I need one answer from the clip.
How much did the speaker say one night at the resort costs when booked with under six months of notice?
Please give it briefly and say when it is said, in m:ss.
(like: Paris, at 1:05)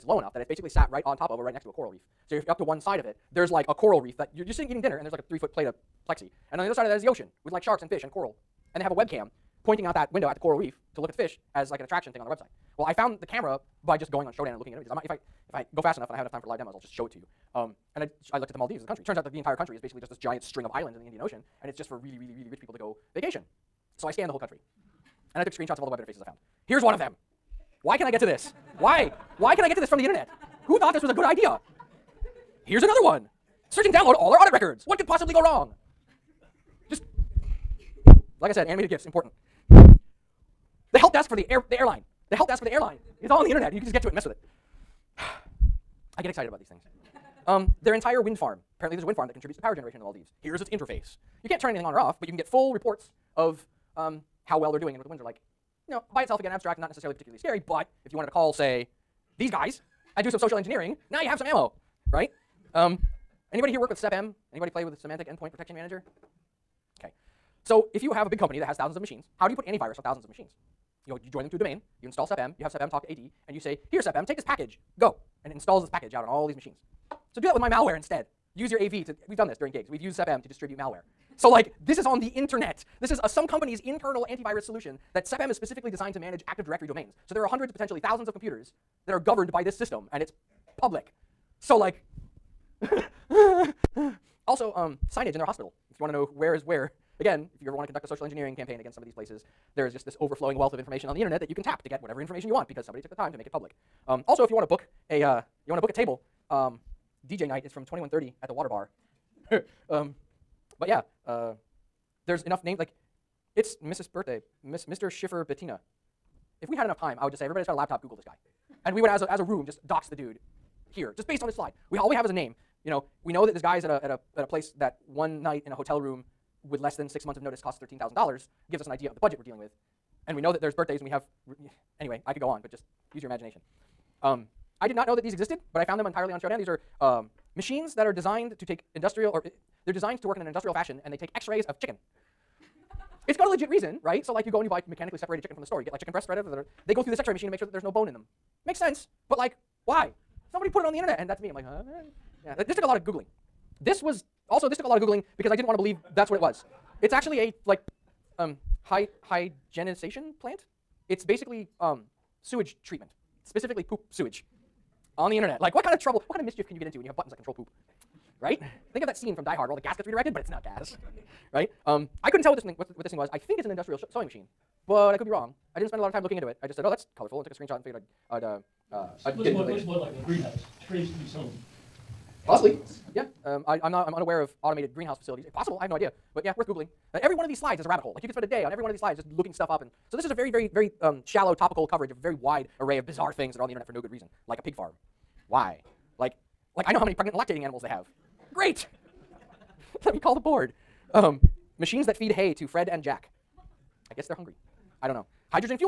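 $13,000, at 2:07.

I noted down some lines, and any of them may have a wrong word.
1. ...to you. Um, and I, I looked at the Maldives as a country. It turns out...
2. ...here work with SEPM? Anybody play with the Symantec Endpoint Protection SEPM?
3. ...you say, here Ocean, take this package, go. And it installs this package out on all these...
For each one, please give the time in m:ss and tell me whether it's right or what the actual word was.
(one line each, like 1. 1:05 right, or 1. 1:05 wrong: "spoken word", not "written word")
1. 0:17 right
2. 1:03 wrong: "Manager", not "SEPM"
3. 1:13 wrong: "SEPM", not "Ocean".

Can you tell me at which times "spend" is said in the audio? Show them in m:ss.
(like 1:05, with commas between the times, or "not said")
2:55, 3:08.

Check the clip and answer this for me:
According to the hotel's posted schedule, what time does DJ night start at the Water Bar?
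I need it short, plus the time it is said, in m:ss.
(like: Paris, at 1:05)
21:30, at 1:47.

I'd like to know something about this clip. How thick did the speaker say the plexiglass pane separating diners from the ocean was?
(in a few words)
3 feet.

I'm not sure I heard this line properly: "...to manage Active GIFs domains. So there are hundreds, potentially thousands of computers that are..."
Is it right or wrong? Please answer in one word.
wrong.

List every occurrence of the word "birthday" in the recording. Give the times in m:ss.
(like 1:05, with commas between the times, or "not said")
1:54, 2:10.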